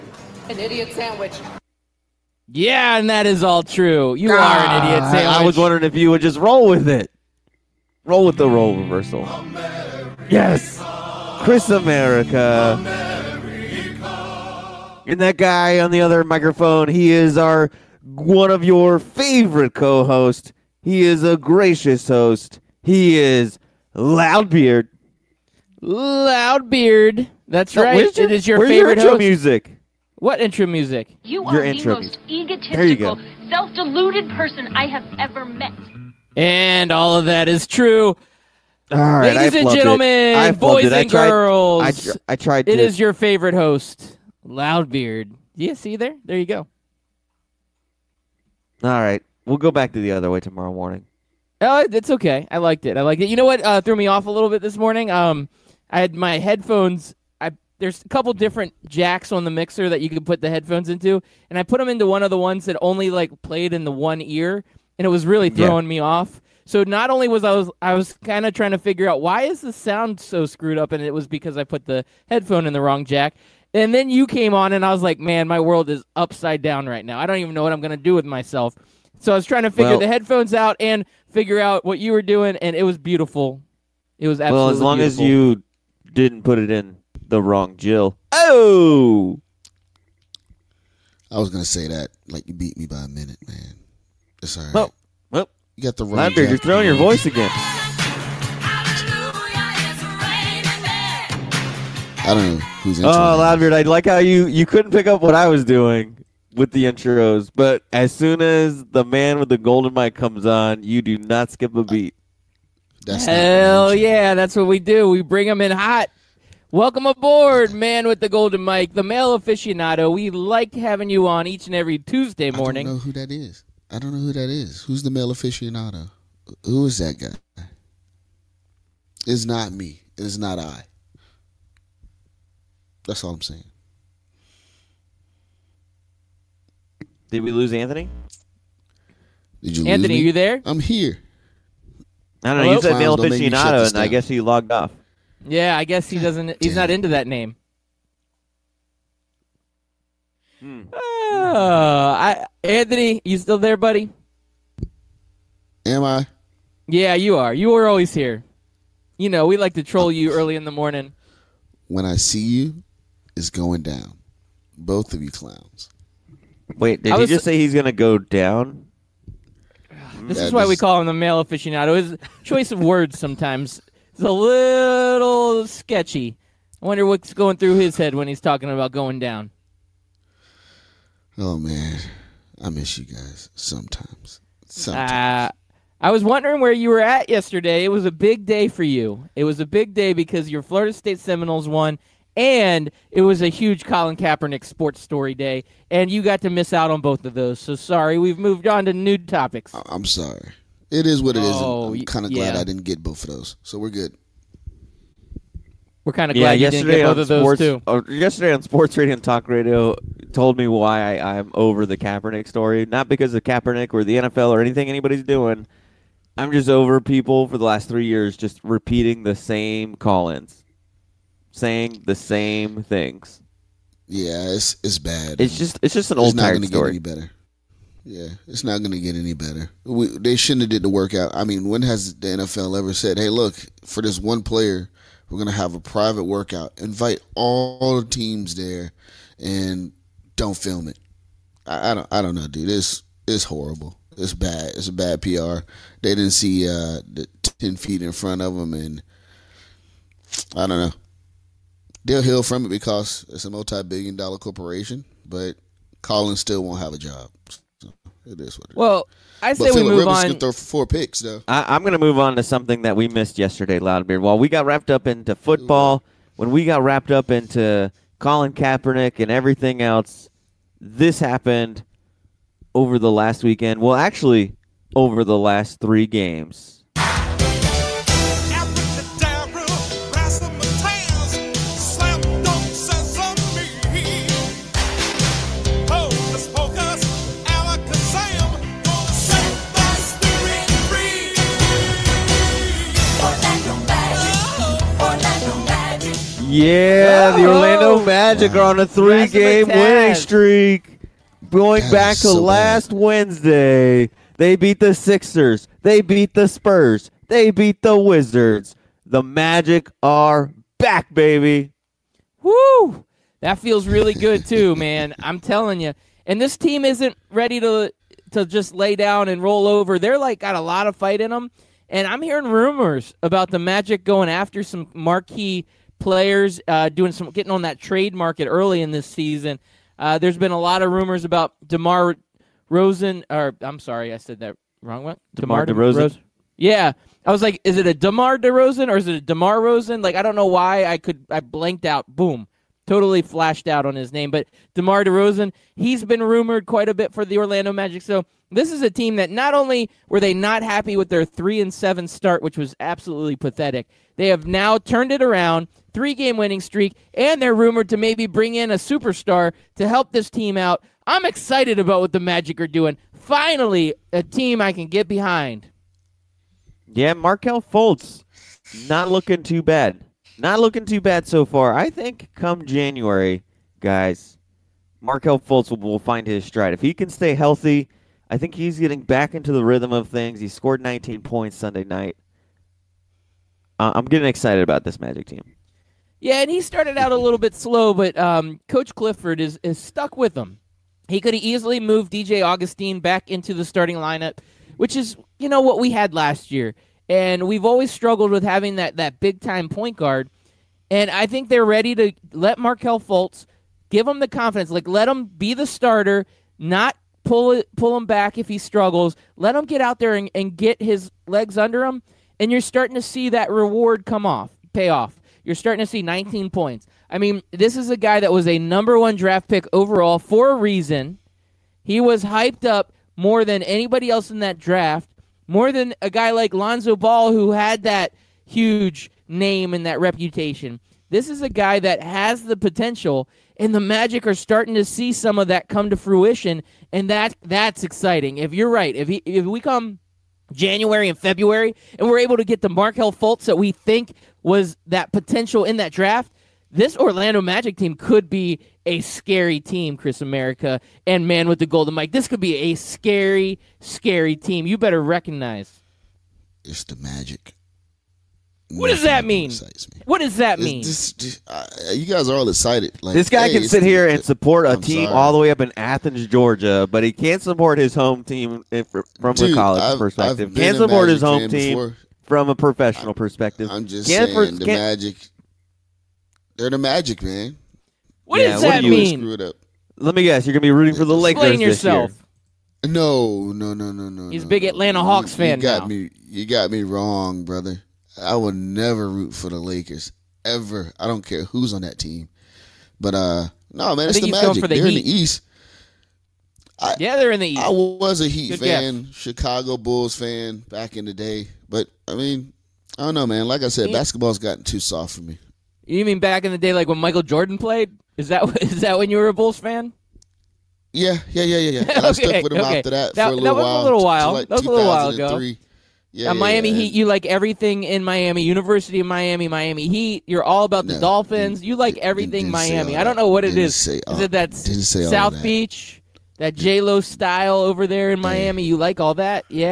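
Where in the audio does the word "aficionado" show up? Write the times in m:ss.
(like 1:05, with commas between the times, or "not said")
1:59, 2:05, 2:23, 2:51.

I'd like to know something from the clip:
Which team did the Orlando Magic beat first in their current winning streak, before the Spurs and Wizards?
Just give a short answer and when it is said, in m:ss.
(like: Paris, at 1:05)
Sixers, at 5:04.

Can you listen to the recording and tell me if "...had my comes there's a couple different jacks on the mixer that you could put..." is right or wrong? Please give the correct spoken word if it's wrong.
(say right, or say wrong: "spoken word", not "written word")
wrong: "headphones", not "comes".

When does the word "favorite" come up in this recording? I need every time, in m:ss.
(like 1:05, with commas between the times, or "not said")
0:18, 0:28, 0:43.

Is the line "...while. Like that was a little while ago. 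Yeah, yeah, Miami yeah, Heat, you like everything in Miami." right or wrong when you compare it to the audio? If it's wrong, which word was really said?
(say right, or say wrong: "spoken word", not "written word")
right.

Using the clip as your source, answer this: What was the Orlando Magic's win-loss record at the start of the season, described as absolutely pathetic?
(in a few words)
3 and 7.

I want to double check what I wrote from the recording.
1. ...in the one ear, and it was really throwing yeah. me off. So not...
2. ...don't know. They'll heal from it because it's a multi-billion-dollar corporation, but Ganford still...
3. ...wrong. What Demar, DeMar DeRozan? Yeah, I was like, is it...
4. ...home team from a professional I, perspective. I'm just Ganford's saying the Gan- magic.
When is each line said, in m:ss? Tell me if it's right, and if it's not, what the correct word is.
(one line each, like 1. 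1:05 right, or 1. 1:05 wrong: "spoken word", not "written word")
1. 1:03 right
2. 4:10 wrong: "Colin", not "Ganford"
3. 5:34 right
4. 7:51 right.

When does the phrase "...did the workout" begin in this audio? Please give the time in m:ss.
3:50.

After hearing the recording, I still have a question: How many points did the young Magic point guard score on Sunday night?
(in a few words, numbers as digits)
19.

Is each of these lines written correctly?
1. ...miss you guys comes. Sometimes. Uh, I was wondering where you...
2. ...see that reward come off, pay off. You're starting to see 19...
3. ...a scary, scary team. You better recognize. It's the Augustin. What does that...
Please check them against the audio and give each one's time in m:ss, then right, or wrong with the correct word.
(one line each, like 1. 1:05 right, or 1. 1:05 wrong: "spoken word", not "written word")
1. 3:02 wrong: "sometimes", not "comes"
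2. 6:53 right
3. 7:32 wrong: "Magic", not "Augustin".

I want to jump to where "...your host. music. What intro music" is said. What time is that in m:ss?
0:28.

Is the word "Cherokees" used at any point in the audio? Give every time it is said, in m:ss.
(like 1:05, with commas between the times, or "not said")
not said.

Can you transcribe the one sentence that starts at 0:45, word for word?
Yeah, see there, there you go.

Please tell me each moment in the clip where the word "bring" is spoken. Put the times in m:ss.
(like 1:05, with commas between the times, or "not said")
1:55, 5:58.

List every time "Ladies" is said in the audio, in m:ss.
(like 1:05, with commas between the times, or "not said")
0:39.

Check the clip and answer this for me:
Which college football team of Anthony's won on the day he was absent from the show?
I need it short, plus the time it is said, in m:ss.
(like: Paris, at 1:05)
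Florida State Seminoles, at 3:10.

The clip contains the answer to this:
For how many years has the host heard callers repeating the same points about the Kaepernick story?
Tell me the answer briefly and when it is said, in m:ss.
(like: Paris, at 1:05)
3, at 3:37.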